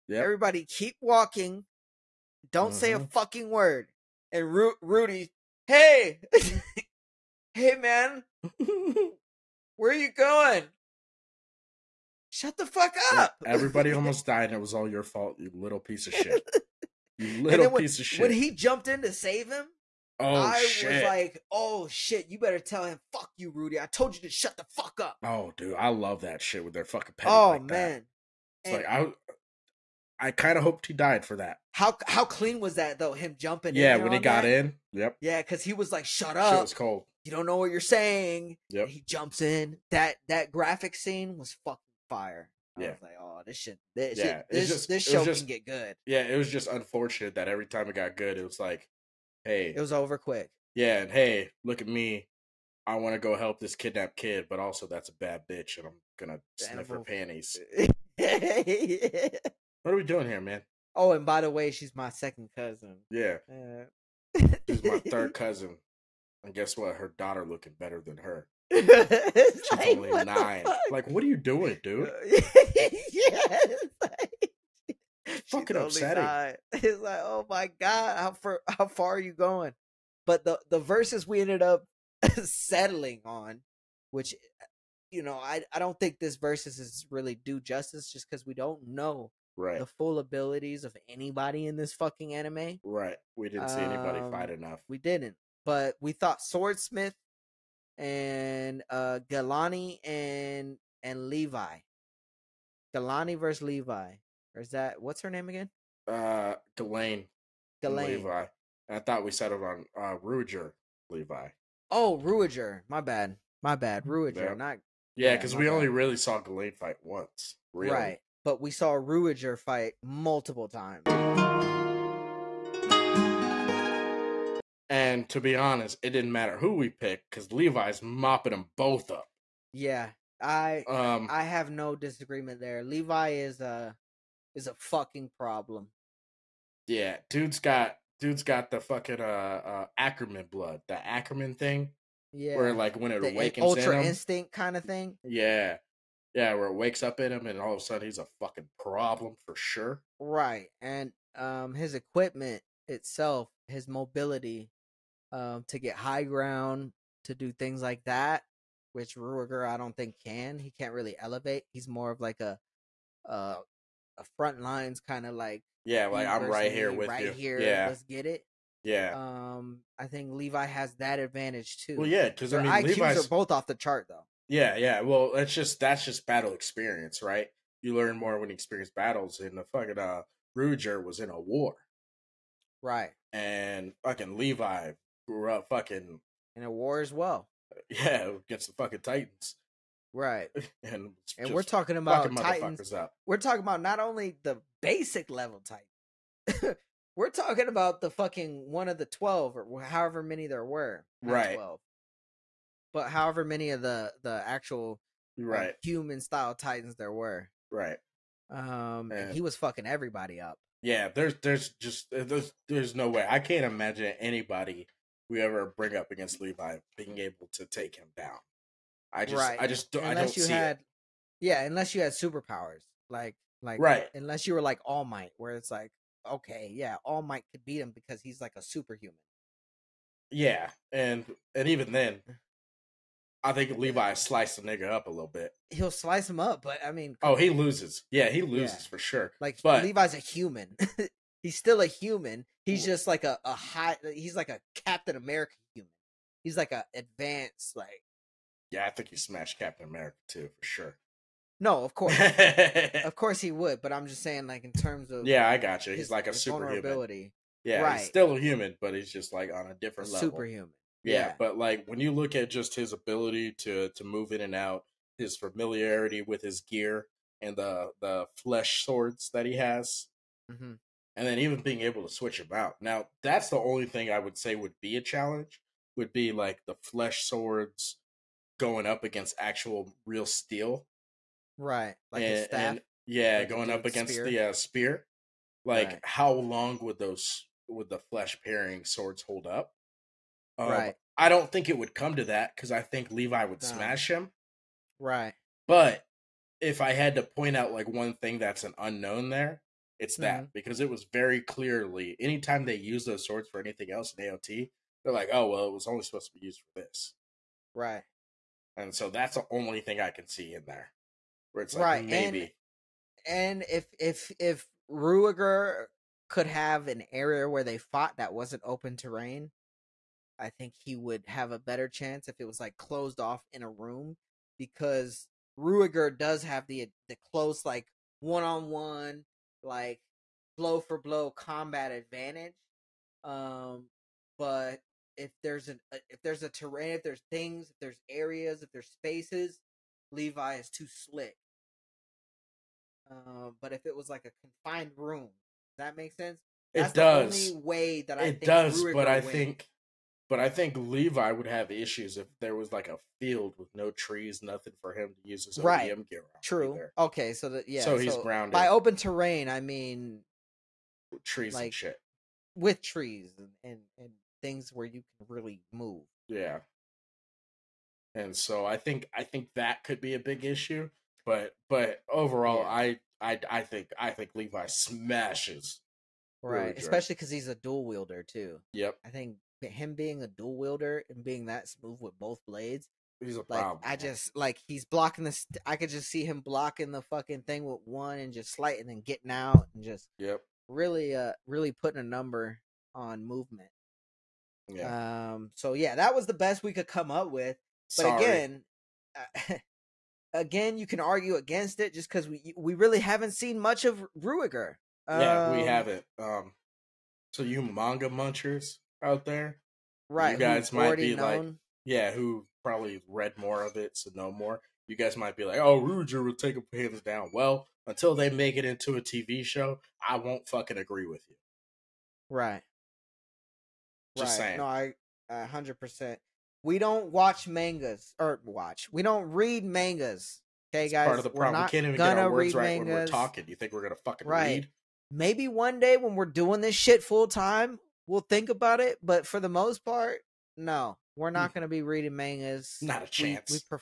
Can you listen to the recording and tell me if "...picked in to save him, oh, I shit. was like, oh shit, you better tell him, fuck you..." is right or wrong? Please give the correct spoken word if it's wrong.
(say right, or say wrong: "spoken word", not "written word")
wrong: "jumped", not "picked".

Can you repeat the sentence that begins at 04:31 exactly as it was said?
and then even being able to switch about out.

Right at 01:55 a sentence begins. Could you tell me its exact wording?
only really saw Galane fight once.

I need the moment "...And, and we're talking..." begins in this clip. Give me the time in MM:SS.
03:10.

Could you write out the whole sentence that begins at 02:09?
Yeah, I um, I have no disagreement there.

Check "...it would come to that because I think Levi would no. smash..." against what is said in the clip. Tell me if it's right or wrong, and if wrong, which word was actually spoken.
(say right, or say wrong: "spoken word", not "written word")
right.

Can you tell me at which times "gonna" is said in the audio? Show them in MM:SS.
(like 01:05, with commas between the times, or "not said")
00:56, 07:13.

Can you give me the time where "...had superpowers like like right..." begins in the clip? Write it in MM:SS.
03:42.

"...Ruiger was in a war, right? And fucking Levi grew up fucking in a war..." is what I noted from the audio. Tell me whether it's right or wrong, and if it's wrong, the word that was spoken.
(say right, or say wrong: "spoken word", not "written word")
right.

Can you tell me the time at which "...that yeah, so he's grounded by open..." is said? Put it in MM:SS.
05:57.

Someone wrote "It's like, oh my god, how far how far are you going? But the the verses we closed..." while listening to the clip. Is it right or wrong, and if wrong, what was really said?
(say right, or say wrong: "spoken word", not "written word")
wrong: "ended", not "closed".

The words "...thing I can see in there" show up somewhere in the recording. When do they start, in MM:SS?
05:09.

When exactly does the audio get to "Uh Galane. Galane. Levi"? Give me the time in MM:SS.
01:46.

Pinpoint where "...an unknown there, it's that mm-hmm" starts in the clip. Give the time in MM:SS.
04:58.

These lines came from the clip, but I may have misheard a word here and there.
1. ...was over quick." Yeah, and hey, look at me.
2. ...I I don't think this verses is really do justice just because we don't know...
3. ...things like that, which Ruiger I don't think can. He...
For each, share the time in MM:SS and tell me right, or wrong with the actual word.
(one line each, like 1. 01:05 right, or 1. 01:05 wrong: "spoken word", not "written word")
1. 00:49 right
2. 01:25 right
3. 02:37 right.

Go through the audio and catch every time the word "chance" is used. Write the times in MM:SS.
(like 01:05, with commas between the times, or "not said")
05:21, 07:23.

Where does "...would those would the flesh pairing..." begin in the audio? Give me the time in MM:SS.
04:46.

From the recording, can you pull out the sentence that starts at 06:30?
Really, uh, really putting a number on movement.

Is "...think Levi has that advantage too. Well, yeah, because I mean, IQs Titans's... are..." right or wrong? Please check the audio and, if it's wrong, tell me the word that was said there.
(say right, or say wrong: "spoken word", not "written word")
wrong: "Levi", not "Titans".